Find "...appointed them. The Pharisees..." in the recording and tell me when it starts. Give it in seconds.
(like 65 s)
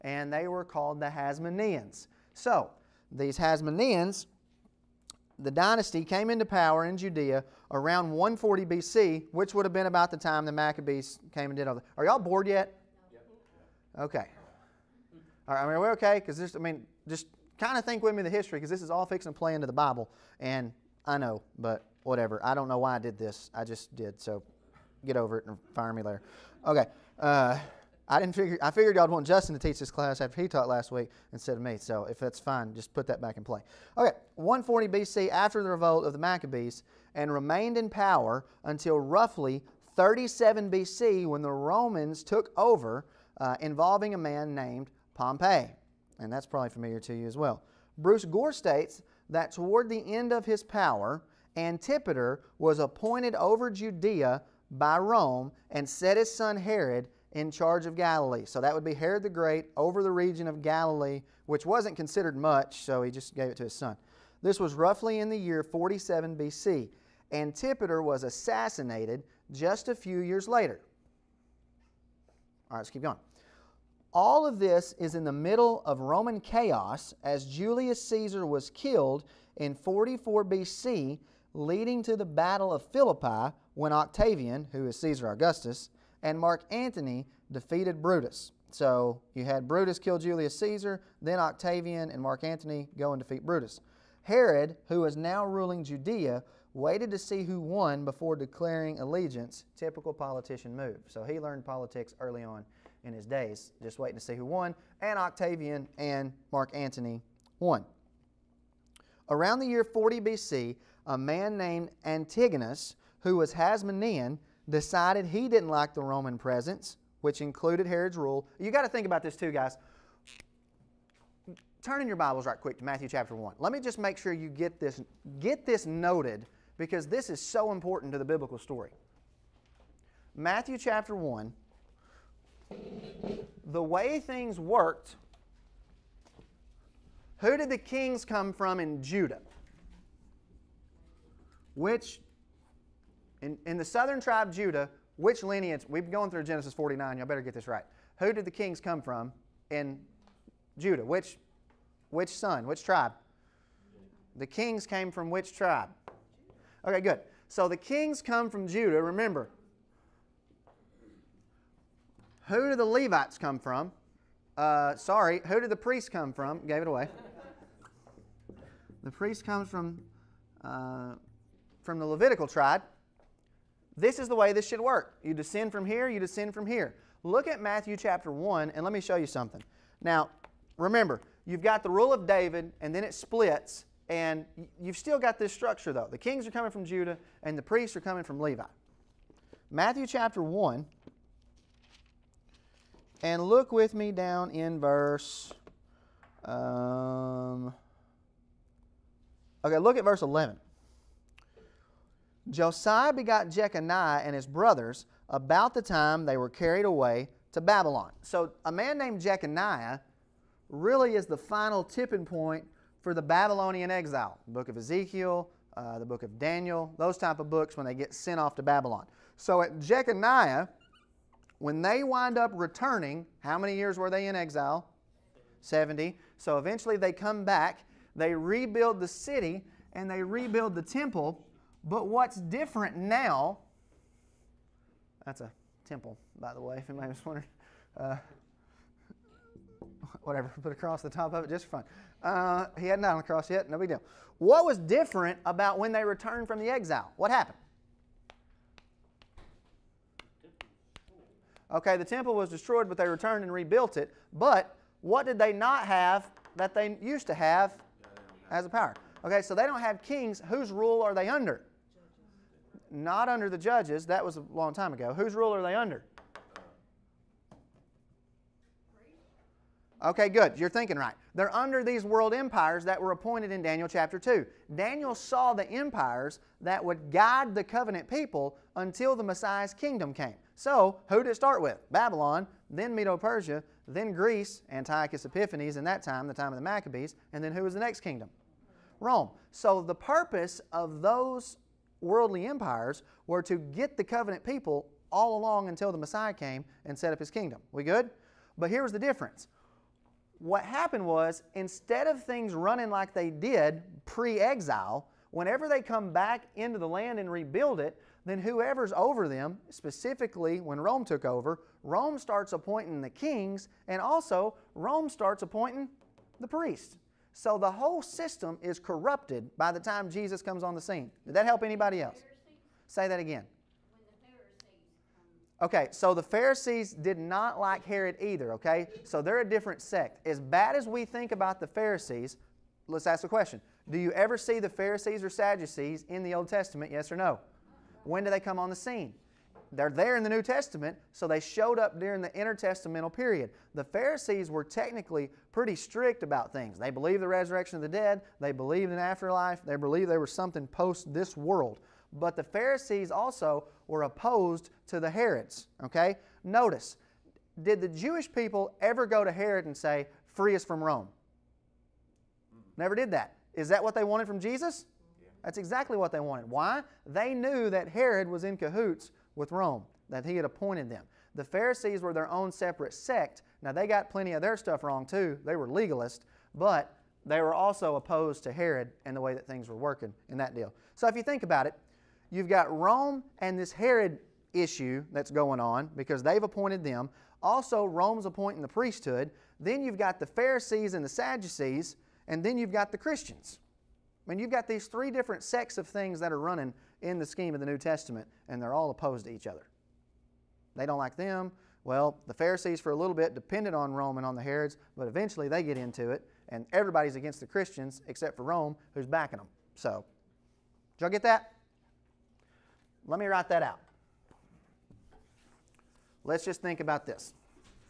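370 s.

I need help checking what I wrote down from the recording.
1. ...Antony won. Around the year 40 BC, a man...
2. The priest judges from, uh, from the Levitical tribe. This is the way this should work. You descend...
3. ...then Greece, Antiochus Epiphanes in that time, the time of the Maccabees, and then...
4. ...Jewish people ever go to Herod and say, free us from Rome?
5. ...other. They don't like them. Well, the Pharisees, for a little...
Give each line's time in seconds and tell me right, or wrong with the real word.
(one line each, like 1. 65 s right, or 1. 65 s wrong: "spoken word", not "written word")
1. 106 s right
2. 169 s wrong: "comes", not "judges"
3. 283 s right
4. 357 s right
5. 399 s right.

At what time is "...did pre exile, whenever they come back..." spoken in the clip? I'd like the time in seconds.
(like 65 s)
303 s.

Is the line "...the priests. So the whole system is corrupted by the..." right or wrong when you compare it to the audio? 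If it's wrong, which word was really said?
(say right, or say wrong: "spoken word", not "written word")
right.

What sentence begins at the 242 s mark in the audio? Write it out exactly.
Uh, he hadn't died on the cross yet, no big deal.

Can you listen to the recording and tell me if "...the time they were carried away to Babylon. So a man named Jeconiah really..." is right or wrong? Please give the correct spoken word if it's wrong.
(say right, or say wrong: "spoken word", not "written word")
right.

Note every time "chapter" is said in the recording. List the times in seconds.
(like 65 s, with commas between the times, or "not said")
123 s, 130 s, 177 s, 190 s, 273 s.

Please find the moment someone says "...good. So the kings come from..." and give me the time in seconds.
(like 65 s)
157 s.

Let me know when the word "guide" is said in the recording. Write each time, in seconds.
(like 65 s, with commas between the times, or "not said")
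277 s.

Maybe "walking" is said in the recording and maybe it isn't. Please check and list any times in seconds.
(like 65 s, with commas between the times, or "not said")
not said.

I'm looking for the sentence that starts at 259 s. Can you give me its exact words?
Okay, so they don't have kings.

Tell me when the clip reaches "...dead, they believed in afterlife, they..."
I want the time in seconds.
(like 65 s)
347 s.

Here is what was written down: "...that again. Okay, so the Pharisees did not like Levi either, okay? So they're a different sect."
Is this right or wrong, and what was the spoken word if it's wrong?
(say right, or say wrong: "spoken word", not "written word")
wrong: "Herod", not "Levi".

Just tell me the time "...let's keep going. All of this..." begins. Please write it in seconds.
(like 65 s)
72 s.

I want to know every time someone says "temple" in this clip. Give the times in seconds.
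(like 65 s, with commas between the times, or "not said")
230 s, 235 s, 252 s.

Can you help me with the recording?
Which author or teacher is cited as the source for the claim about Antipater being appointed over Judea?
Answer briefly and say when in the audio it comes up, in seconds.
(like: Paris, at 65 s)
Bruce Gore, at 47 s.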